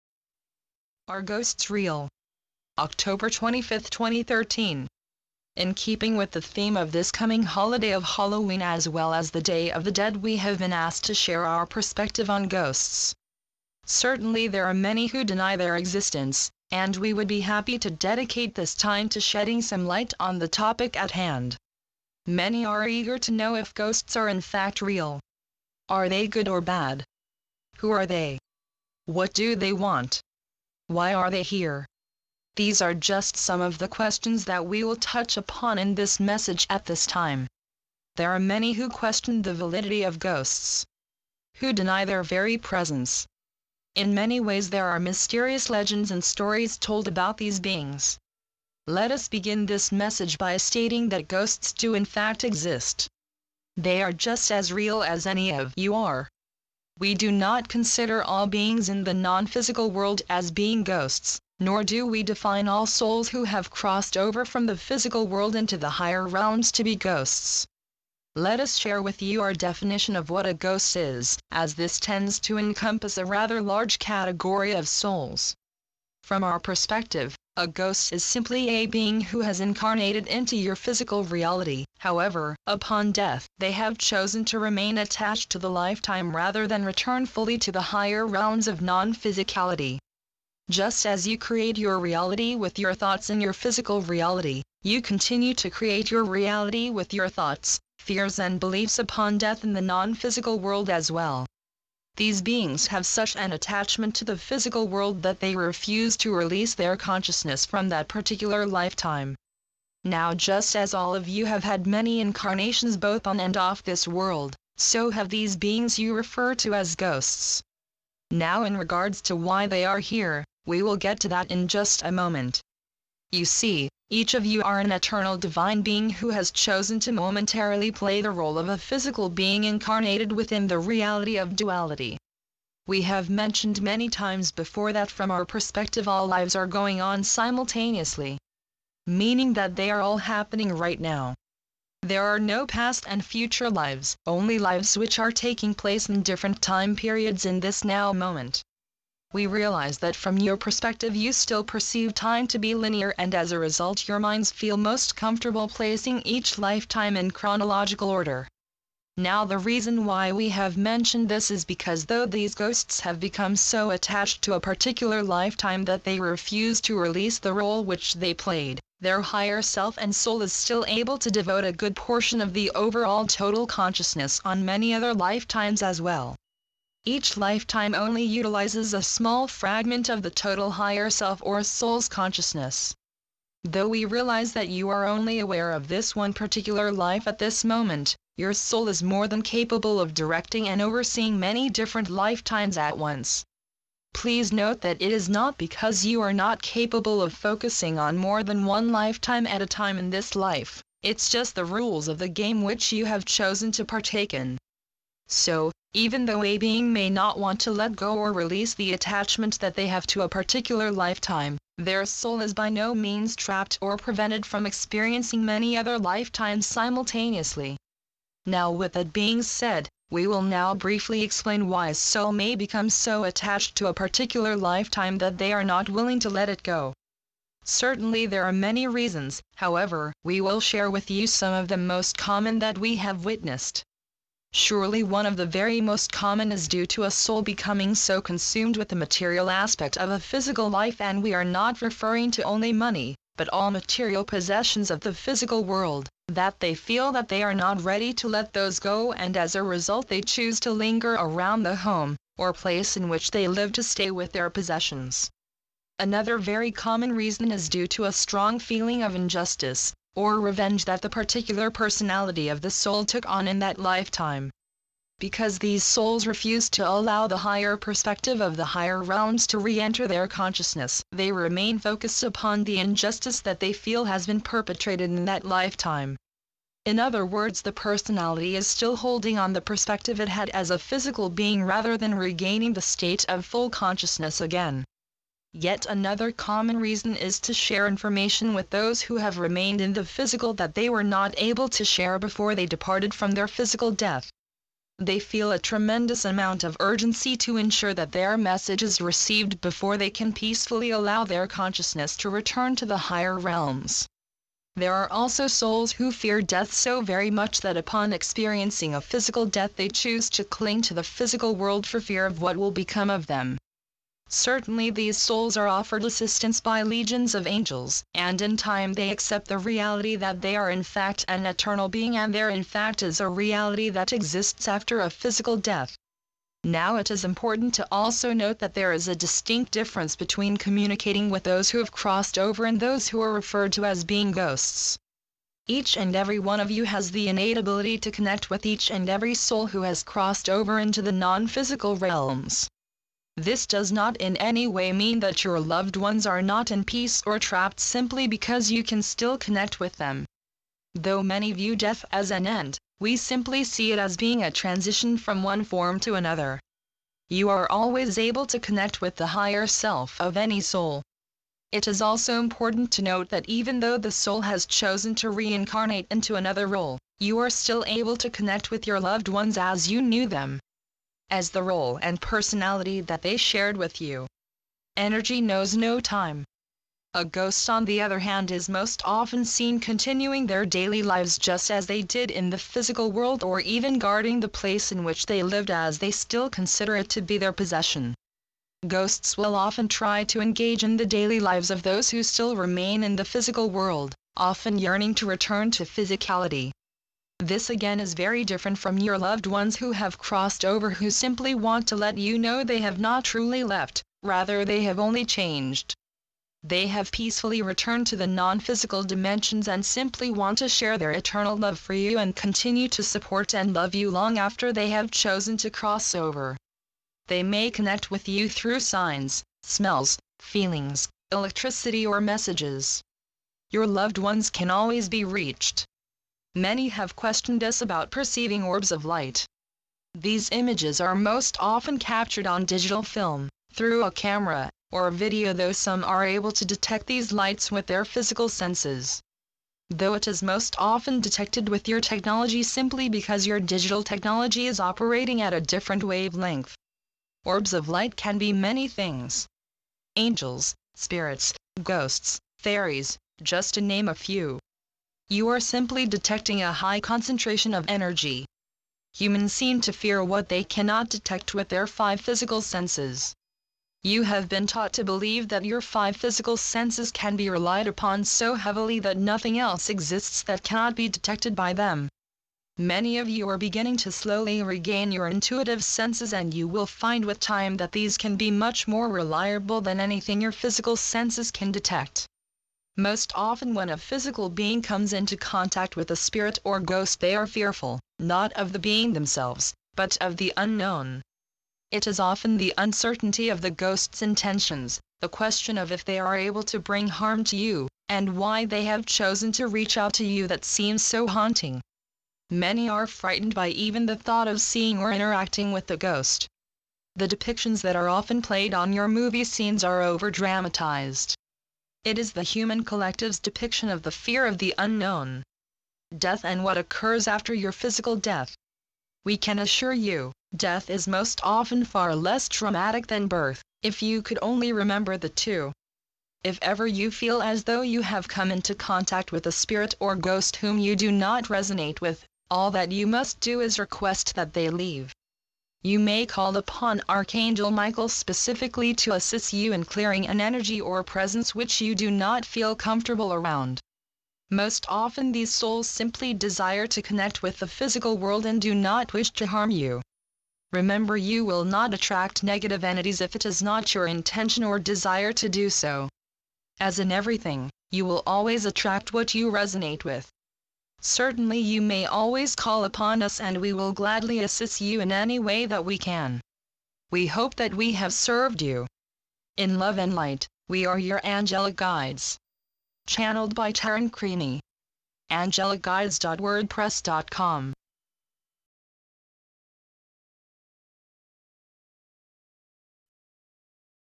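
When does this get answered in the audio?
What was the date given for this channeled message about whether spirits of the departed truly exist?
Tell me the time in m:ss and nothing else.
0:02.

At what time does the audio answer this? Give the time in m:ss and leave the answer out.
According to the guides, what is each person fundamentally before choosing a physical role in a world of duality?
2:04.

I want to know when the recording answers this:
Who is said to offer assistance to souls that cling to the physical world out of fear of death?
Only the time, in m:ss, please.
5:16.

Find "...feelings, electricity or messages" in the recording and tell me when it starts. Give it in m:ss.
7:00.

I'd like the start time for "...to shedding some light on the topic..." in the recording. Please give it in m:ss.
0:19.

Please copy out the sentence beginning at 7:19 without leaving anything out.
Though it is most often detected with your technology simply because your digital technology is operating at a different wavelength.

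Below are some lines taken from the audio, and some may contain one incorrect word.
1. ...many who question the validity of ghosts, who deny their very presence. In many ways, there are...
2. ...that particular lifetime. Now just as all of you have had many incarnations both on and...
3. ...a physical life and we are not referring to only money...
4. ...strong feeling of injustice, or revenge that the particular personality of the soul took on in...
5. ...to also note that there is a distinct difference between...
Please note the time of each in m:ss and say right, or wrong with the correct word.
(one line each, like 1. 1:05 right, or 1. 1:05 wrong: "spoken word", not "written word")
1. 0:38 right
2. 1:47 right
3. 4:00 right
4. 4:18 right
5. 5:27 right.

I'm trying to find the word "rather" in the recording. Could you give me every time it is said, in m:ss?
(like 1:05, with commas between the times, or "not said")
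1:13, 1:26, 4:41, 6:44.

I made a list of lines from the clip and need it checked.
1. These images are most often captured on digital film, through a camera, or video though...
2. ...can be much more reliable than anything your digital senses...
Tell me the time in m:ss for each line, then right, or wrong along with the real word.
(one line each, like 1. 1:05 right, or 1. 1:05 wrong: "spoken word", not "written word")
1. 7:10 right
2. 7:58 wrong: "physical", not "digital".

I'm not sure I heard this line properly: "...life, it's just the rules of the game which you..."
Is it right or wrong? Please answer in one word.
right.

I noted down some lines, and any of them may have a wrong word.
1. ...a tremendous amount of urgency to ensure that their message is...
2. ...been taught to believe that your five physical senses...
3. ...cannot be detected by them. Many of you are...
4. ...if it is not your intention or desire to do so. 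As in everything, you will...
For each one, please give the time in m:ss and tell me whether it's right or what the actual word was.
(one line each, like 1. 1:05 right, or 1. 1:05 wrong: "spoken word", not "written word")
1. 4:55 right
2. 7:44 right
3. 7:50 right
4. 9:13 right.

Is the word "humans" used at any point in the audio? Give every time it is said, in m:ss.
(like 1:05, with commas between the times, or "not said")
7:39, 8:32.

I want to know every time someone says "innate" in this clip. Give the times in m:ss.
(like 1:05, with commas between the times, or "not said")
5:37.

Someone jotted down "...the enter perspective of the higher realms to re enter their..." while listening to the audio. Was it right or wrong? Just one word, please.
wrong.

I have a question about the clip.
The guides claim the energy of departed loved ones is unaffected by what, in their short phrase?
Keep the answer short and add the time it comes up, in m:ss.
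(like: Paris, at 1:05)
Energy knows no time, at 6:14.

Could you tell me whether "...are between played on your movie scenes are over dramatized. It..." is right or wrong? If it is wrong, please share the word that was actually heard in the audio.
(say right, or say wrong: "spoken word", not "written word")
wrong: "often", not "between".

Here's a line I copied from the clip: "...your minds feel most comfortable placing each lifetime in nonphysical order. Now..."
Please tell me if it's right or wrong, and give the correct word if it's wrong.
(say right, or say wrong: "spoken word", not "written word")
wrong: "chronological", not "nonphysical".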